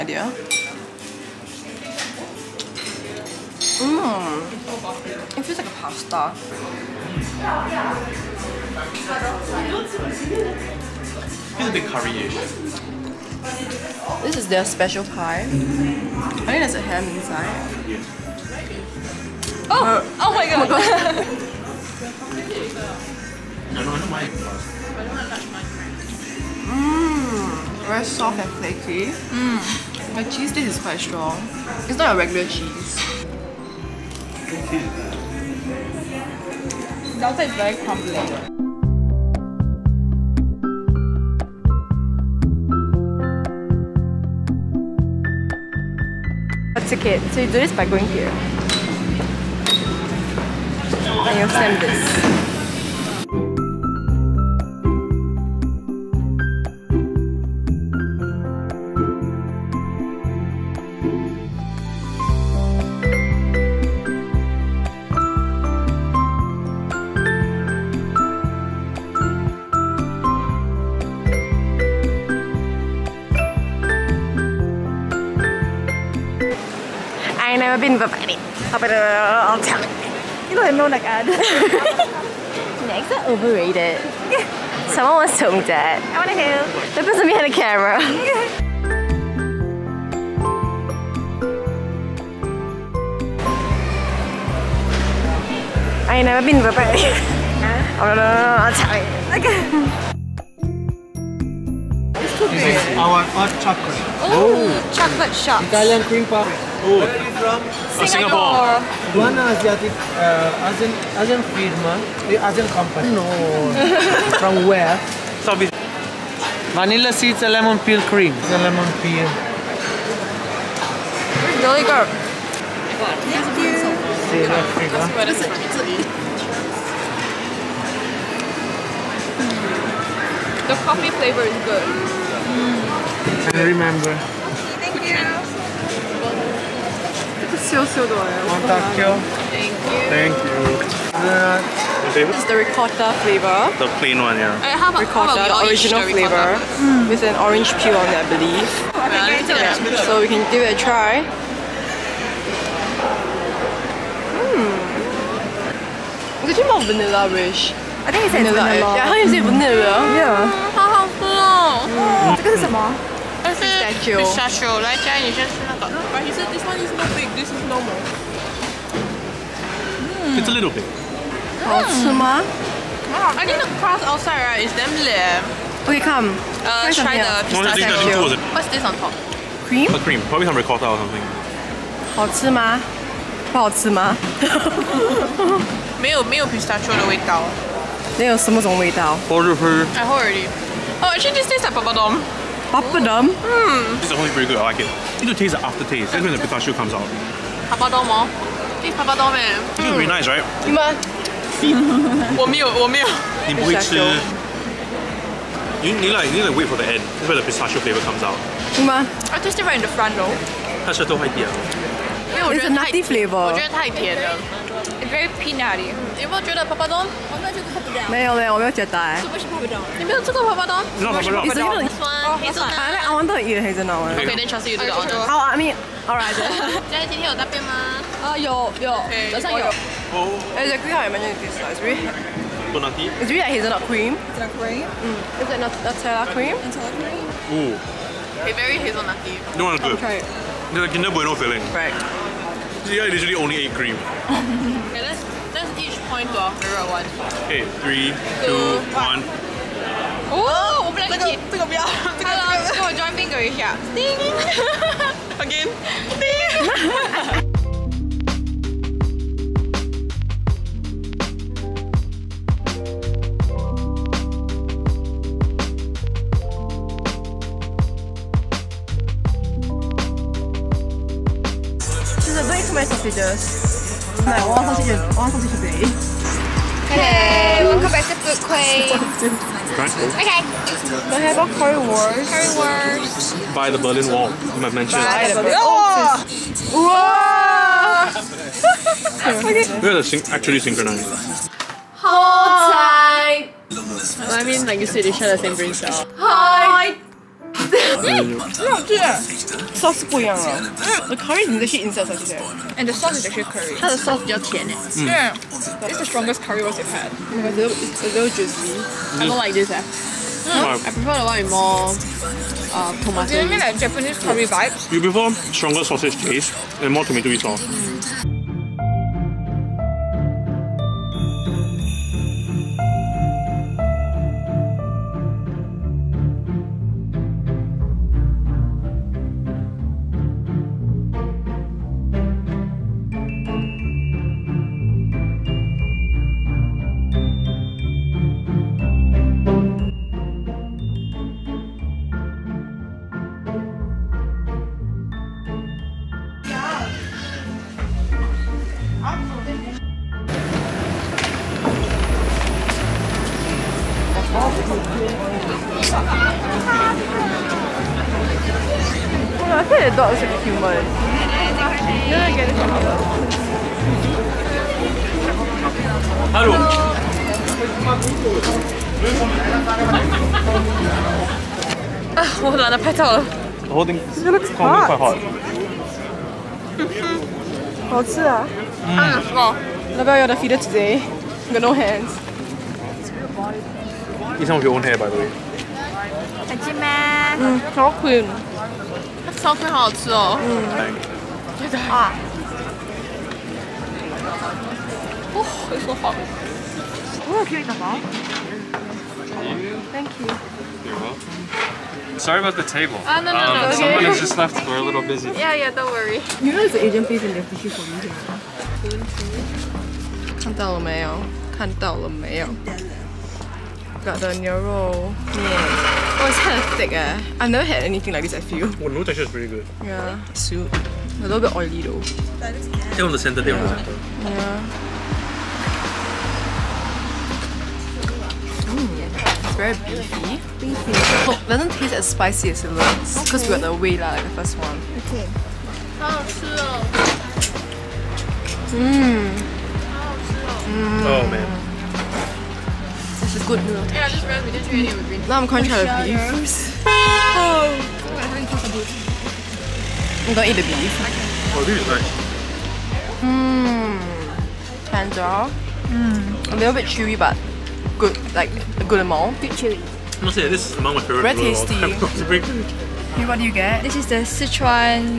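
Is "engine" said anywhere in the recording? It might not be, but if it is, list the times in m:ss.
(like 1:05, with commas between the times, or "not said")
not said.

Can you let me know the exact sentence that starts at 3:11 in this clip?
Oh, actually, this tastes like papadum.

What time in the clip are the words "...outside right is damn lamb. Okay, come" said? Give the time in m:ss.
2:54.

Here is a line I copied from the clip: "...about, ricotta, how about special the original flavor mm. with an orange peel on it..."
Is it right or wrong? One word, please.
wrong.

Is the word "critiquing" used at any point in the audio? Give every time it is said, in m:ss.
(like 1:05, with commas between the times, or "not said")
not said.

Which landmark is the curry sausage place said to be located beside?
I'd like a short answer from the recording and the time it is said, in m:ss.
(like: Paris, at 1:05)
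Berlin Wall, at 4:43.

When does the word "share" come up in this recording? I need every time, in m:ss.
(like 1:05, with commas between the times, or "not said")
4:55.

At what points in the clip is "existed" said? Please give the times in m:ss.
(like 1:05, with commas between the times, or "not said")
not said.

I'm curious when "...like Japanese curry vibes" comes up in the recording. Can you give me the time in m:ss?
5:13.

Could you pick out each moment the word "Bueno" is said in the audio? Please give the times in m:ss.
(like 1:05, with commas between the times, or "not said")
4:01.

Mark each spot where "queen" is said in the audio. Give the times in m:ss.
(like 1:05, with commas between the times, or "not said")
4:38, 6:28.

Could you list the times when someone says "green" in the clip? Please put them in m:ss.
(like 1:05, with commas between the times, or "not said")
7:25.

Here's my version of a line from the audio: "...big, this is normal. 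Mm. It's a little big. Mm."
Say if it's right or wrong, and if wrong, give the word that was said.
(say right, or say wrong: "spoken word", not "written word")
right.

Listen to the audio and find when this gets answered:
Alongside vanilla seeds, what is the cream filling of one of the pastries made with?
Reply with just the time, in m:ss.
1:56.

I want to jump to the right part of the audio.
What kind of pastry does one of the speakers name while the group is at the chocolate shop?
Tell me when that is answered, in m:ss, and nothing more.
1:45.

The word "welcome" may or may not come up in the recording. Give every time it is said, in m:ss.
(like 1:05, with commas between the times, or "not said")
4:37, 6:40.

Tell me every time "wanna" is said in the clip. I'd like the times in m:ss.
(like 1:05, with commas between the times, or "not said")
1:26.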